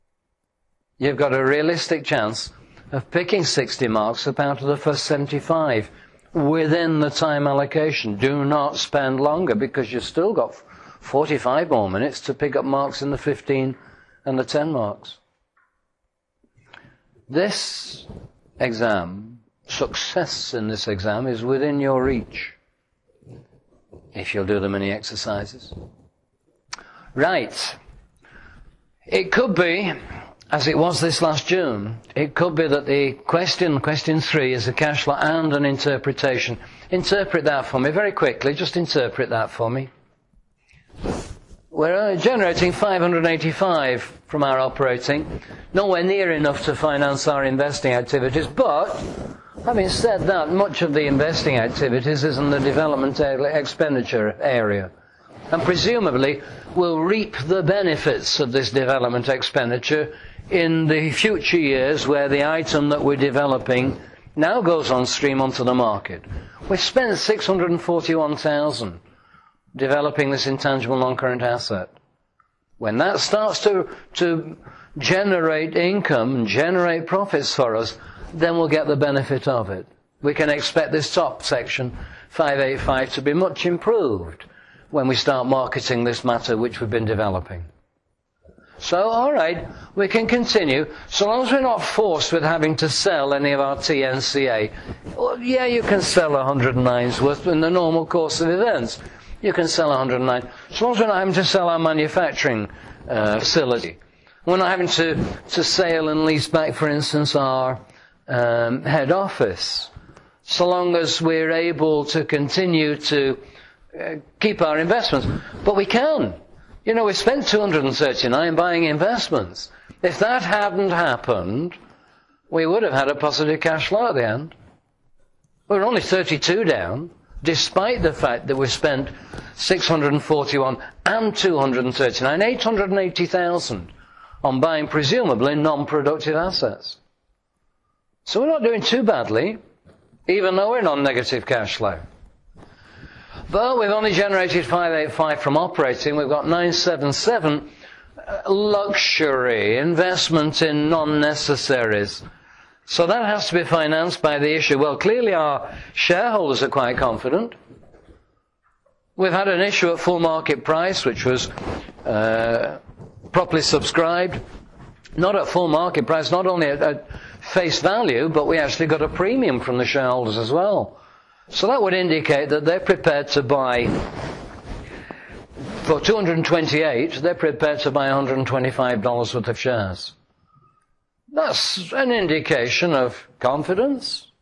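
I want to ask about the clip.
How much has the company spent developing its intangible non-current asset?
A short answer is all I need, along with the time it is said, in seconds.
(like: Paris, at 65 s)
641,000, at 67 s.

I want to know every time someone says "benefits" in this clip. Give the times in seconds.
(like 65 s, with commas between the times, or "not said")
57 s, 78 s.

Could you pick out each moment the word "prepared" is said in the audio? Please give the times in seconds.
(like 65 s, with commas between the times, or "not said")
172 s, 177 s.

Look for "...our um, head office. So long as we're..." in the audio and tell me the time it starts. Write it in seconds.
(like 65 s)
107 s.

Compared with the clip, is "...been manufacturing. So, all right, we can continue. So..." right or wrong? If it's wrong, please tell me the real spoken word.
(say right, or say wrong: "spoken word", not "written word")
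wrong: "developing", not "manufacturing".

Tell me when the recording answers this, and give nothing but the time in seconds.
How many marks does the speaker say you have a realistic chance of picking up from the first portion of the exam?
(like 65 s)
3 s.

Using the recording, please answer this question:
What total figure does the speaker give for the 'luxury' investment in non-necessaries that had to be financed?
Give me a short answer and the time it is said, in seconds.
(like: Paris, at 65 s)
977, at 146 s.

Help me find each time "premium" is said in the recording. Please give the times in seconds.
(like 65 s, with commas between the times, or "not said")
169 s.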